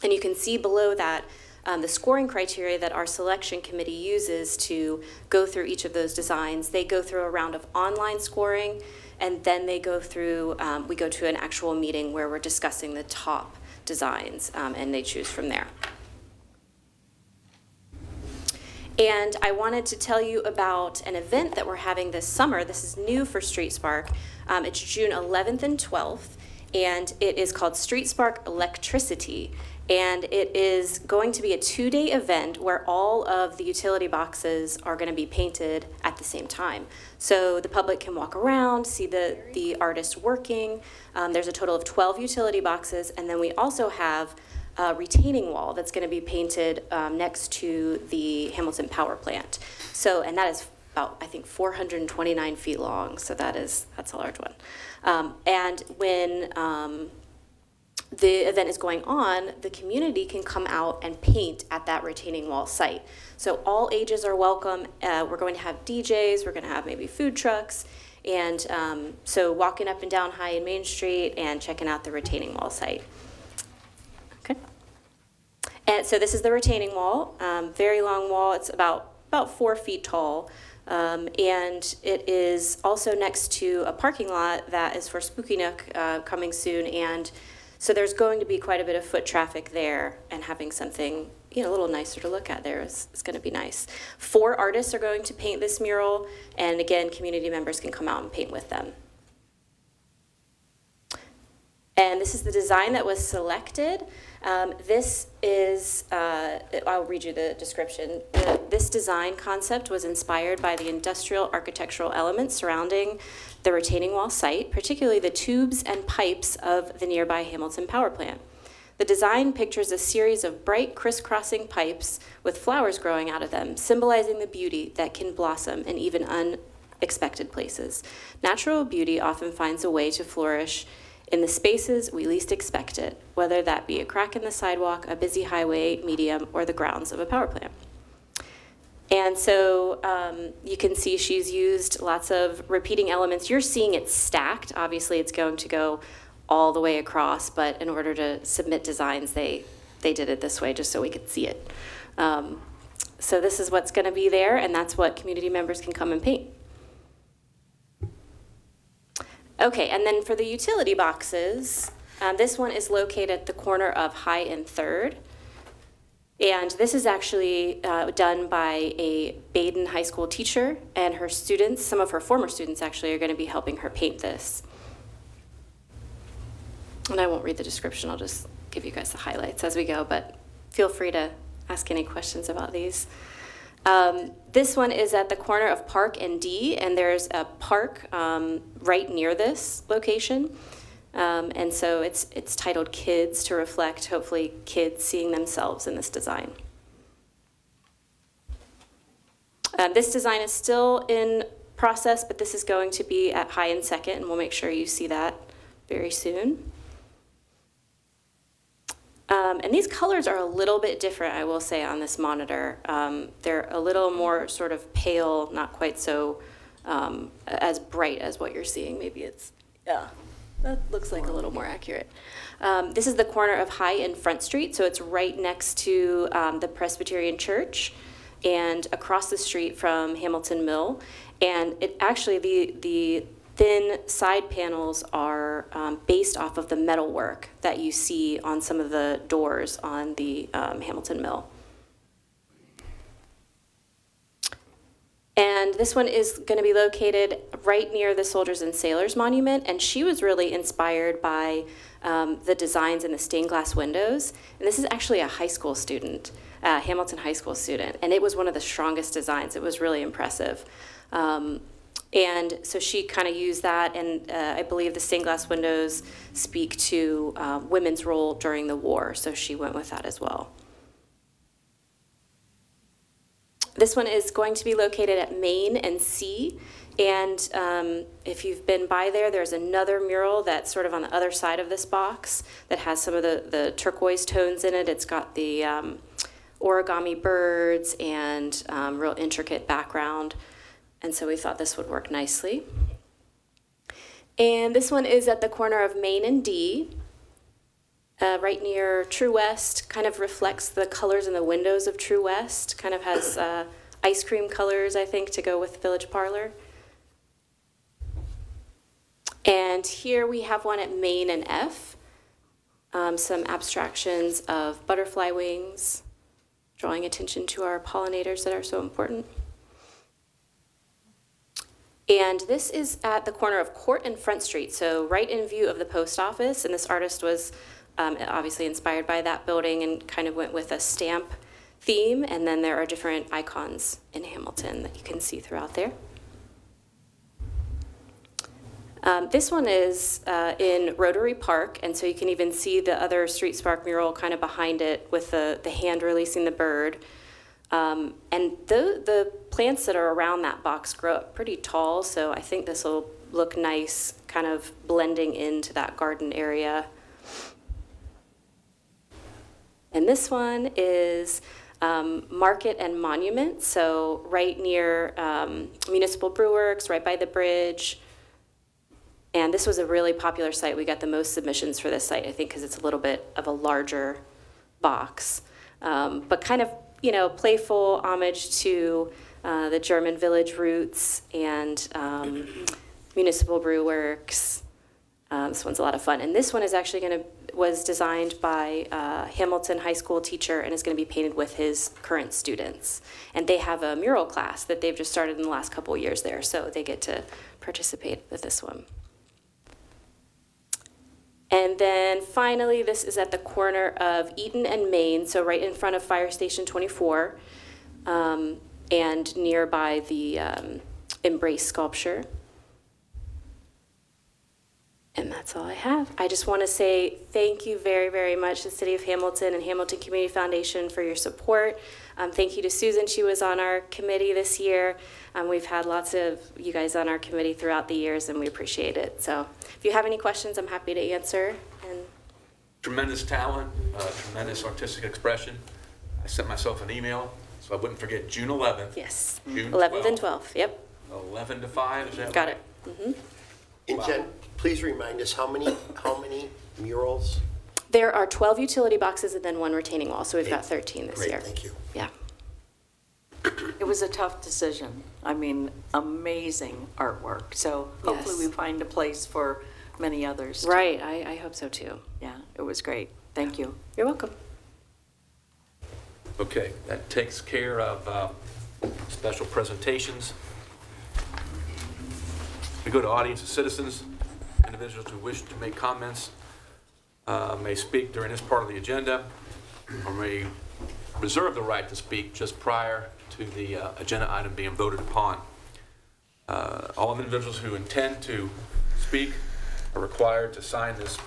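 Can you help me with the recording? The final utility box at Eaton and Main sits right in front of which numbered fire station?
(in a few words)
Fire Station 24.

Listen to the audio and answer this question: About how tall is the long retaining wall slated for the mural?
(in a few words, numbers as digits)
4 feet.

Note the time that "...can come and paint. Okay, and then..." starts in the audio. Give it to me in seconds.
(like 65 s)
155 s.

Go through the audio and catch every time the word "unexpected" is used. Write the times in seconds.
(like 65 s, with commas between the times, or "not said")
126 s.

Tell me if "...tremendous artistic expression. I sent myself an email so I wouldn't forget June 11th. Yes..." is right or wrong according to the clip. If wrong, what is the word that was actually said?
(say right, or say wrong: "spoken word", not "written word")
right.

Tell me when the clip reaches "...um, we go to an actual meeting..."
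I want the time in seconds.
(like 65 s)
10 s.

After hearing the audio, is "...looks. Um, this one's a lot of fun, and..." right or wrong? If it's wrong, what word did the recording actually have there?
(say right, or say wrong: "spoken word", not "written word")
wrong: "works", not "looks".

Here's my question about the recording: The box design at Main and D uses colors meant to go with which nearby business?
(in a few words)
Village Parlor.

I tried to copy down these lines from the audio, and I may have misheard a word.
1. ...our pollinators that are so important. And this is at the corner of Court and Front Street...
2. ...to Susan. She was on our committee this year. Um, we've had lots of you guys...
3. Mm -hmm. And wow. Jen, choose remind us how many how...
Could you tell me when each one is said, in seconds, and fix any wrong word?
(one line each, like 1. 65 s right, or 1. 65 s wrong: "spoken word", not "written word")
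1. 317 s right
2. 422 s right
3. 442 s wrong: "please", not "choose".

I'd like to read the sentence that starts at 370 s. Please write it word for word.
We got the most submissions for this site, I think, because it's a little bit of a larger box.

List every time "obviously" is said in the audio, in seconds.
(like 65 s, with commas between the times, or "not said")
144 s, 328 s.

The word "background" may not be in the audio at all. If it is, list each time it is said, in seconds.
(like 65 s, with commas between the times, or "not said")
289 s.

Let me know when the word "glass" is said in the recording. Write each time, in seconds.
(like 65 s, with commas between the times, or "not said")
253 s, 265 s.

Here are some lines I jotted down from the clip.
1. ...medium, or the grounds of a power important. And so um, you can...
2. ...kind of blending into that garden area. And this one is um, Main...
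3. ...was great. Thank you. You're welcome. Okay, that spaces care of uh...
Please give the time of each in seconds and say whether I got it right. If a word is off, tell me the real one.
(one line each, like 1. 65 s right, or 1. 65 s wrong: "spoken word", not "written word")
1. 136 s wrong: "plant", not "important"
2. 354 s wrong: "Market", not "Main"
3. 462 s wrong: "takes", not "spaces".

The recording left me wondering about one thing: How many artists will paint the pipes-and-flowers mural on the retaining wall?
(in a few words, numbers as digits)
4.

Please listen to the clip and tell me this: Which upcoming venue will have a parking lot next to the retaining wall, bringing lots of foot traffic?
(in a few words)
Spooky Nook.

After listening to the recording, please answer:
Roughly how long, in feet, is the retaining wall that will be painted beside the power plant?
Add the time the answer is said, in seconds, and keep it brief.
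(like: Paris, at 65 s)
429 feet, at 51 s.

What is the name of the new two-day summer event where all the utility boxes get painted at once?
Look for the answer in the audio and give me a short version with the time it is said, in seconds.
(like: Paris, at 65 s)
Street Spark Electricity, at 27 s.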